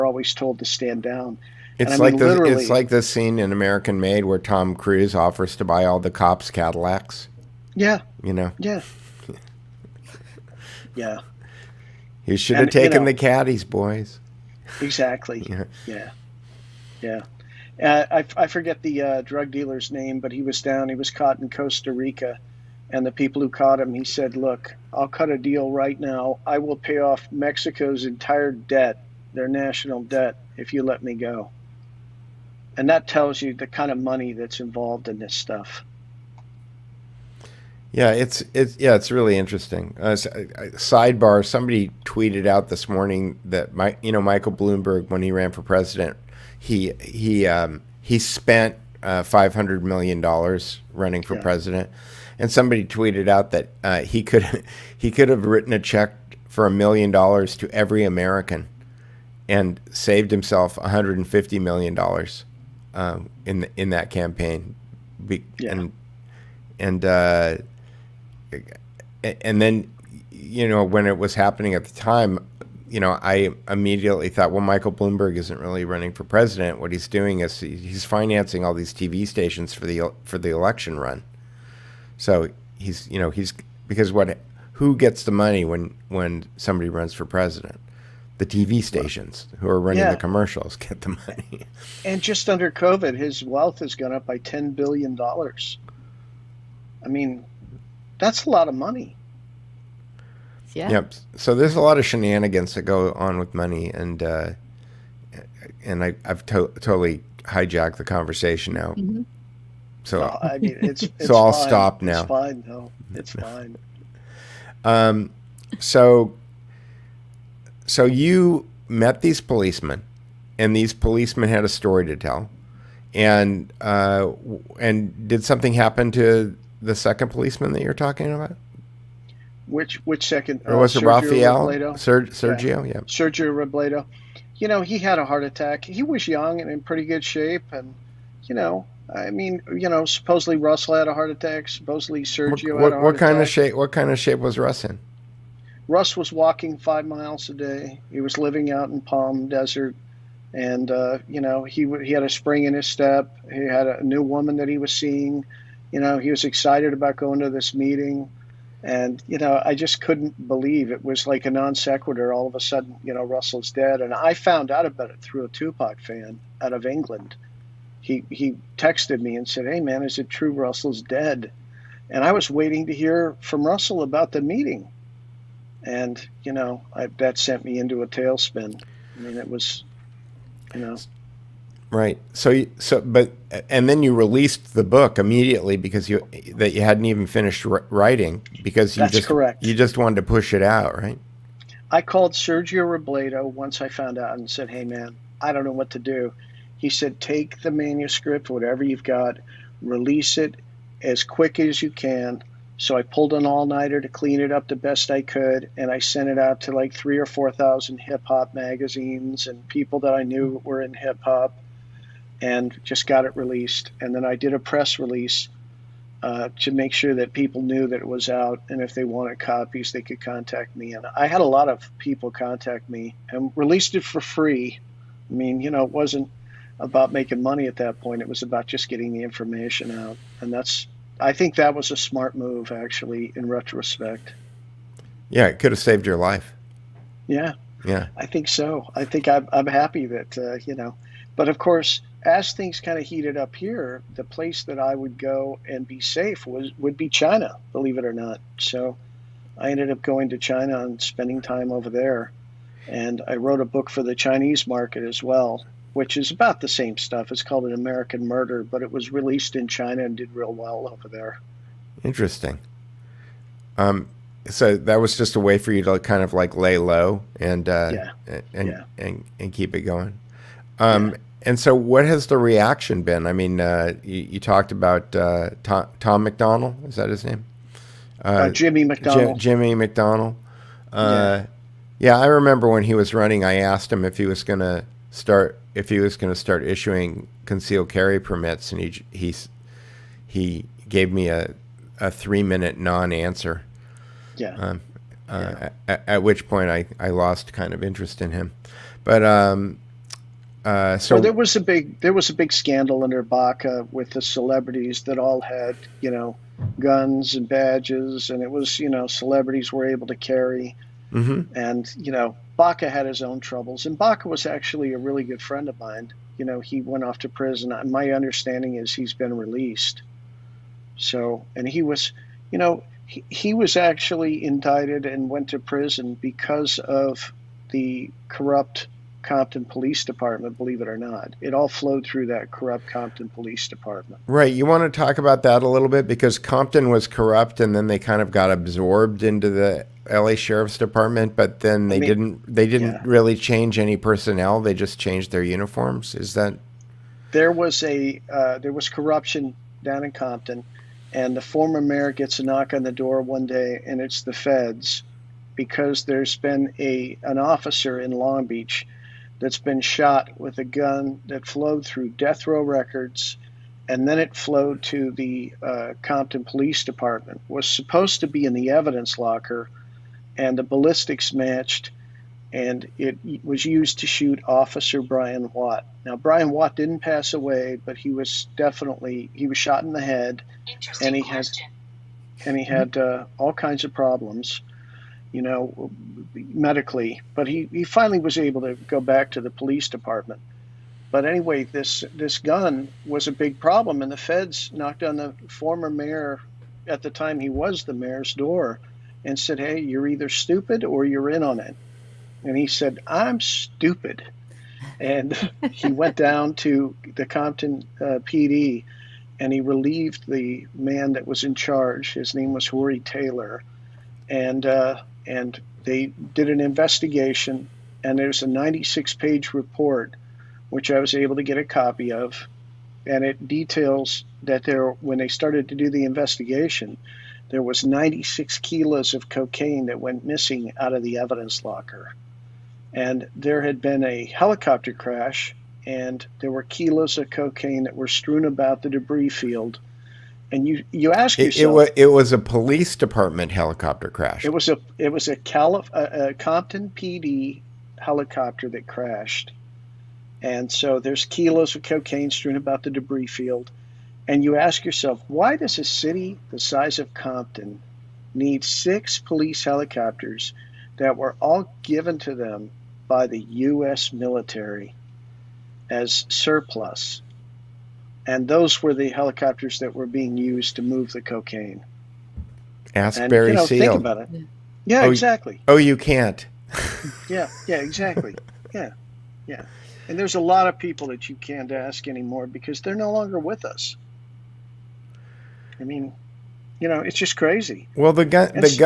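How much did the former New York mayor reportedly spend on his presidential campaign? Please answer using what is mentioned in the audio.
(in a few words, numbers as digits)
$500 million.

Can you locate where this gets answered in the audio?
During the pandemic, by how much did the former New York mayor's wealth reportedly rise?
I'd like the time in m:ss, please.
1:34.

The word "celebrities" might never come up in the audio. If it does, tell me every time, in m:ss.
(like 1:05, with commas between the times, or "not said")
5:04, 5:09.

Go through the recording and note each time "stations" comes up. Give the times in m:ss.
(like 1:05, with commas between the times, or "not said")
1:19, 1:28.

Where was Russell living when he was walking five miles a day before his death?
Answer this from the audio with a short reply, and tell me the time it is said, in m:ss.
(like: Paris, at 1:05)
Palm Desert, at 2:28.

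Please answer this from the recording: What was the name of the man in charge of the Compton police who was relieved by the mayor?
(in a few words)
Rory Taylor.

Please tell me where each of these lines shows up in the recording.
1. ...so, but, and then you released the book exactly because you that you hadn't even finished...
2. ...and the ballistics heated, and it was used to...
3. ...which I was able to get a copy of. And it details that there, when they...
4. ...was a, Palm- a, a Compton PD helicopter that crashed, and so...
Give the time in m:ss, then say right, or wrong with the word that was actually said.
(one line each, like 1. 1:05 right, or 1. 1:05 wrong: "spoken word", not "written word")
1. 3:02 wrong: "immediately", not "exactly"
2. 6:10 wrong: "matched", not "heated"
3. 7:00 right
4. 7:25 wrong: "Calif", not "Palm".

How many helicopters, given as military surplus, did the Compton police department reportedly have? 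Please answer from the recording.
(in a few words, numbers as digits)
6.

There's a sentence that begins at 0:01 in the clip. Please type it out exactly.
It's like mean, the, it's like the scene in American Made where Tom Cruise offers to buy all the cops Cadillacs.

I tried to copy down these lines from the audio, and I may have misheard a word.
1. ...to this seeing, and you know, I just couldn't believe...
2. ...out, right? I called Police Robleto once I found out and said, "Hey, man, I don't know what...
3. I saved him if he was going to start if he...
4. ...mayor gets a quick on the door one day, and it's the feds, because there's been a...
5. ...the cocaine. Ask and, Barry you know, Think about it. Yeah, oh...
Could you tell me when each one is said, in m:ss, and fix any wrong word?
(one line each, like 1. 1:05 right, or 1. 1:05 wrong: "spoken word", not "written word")
1. 2:37 wrong: "meeting", not "seeing"
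2. 3:10 wrong: "Sergio", not "Police"
3. 4:43 wrong: "asked", not "saved"
4. 5:51 wrong: "knock", not "quick"
5. 7:51 right.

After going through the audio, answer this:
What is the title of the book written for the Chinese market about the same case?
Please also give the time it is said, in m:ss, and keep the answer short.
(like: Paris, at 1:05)
An American Murder, at 4:17.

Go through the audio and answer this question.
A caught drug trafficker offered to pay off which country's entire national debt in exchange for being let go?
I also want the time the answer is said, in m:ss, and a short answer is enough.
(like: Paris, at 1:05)
Mexico, at 0:27.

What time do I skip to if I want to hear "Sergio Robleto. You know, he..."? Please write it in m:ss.
2:13.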